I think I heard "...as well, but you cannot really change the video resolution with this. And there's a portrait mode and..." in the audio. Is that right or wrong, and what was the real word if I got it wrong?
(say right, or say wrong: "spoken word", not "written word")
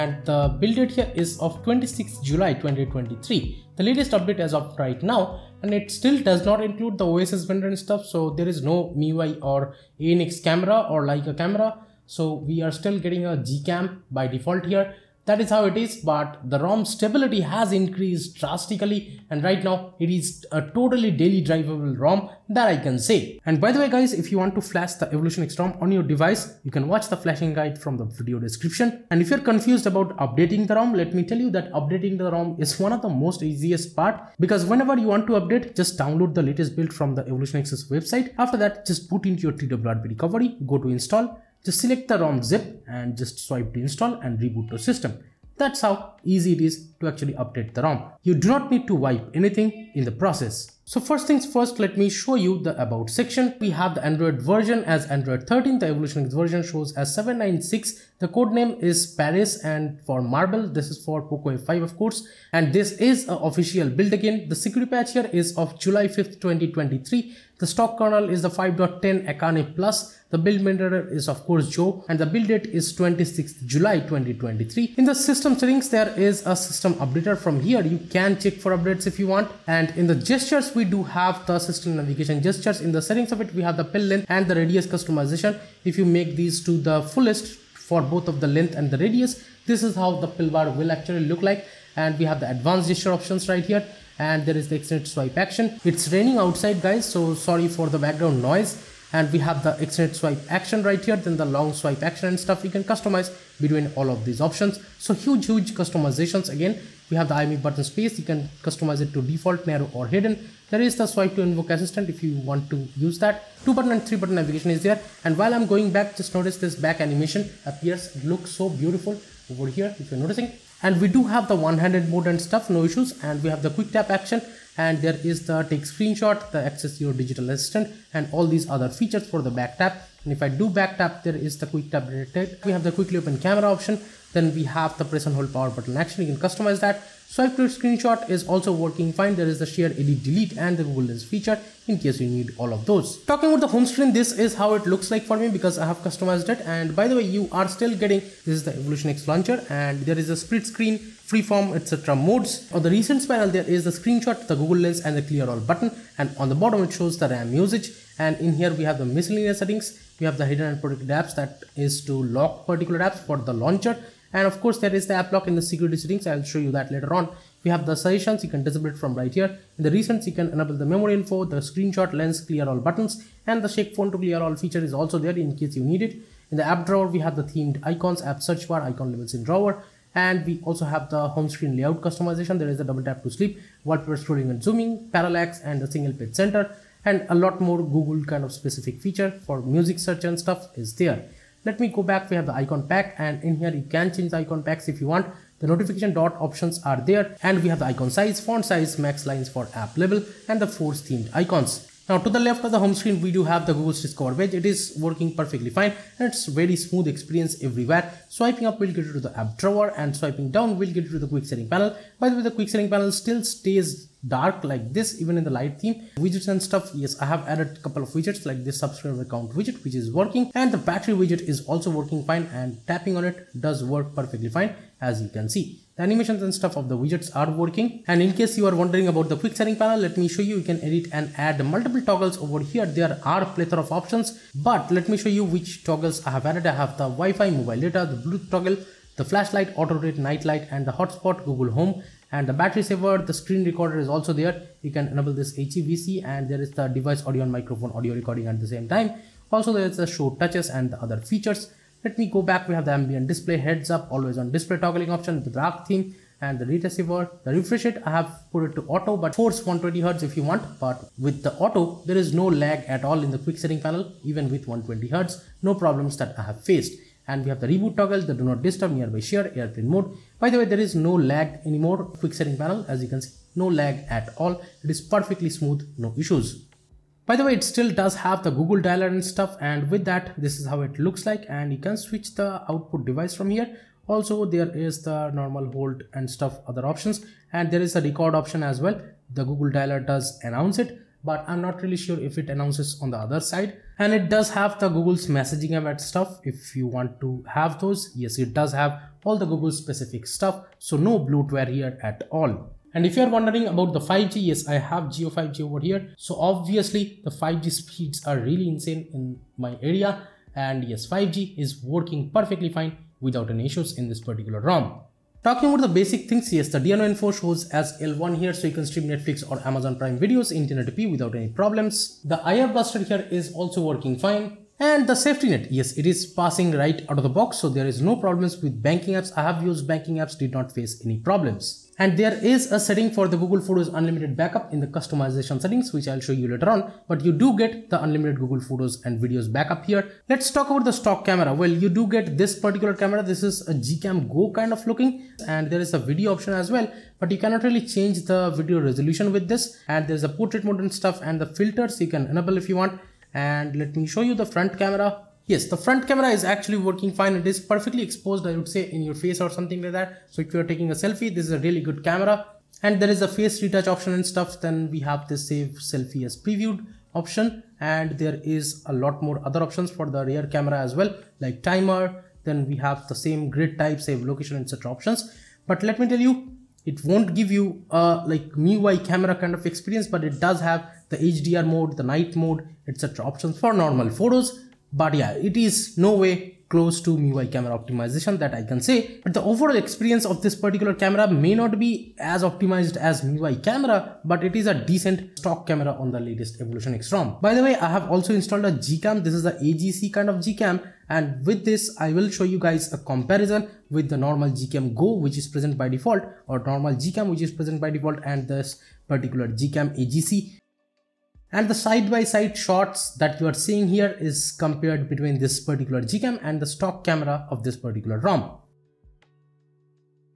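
right.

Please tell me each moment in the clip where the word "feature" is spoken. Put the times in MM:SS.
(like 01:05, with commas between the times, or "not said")
02:08, 02:21, 02:54, 03:09, 04:11.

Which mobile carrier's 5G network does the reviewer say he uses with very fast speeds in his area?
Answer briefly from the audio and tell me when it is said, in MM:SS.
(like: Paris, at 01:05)
Jio, at 05:05.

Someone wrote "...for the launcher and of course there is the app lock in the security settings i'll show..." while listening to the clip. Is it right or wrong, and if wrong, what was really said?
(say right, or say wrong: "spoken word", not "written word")
right.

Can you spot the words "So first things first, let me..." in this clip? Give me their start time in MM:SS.
00:50.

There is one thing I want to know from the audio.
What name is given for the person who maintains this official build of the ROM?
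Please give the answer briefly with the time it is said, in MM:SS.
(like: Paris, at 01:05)
Joe, at 01:11.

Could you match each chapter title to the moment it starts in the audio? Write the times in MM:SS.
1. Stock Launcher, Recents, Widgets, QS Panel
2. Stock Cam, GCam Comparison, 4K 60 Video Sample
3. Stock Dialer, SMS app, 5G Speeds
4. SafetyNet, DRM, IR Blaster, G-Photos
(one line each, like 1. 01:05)
1. 02:23
2. 05:40
3. 04:37
4. 05:15.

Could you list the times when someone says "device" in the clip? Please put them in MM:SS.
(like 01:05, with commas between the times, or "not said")
00:26, 04:06, 04:43.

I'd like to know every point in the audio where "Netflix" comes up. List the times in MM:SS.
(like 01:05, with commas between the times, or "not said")
05:19.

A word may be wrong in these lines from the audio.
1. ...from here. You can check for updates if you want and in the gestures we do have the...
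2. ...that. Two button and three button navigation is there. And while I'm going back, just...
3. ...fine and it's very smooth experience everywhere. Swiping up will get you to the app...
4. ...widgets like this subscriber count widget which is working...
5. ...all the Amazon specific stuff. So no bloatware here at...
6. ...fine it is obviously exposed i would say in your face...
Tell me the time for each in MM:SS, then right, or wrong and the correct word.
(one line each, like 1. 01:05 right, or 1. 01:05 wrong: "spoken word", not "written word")
1. 01:17 right
2. 01:53 right
3. 03:25 right
4. 03:38 right
5. 04:59 wrong: "Google", not "Amazon"
6. 05:57 wrong: "perfectly", not "obviously".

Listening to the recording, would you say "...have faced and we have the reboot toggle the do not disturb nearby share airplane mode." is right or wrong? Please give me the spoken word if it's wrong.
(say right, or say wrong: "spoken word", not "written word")
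right.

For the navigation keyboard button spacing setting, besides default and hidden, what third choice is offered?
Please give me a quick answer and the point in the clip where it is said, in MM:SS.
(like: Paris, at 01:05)
narrow, at 01:49.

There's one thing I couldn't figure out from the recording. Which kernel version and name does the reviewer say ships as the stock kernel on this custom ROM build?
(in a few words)
5.10 Akane Plus.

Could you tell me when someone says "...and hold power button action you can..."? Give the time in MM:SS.
02:15.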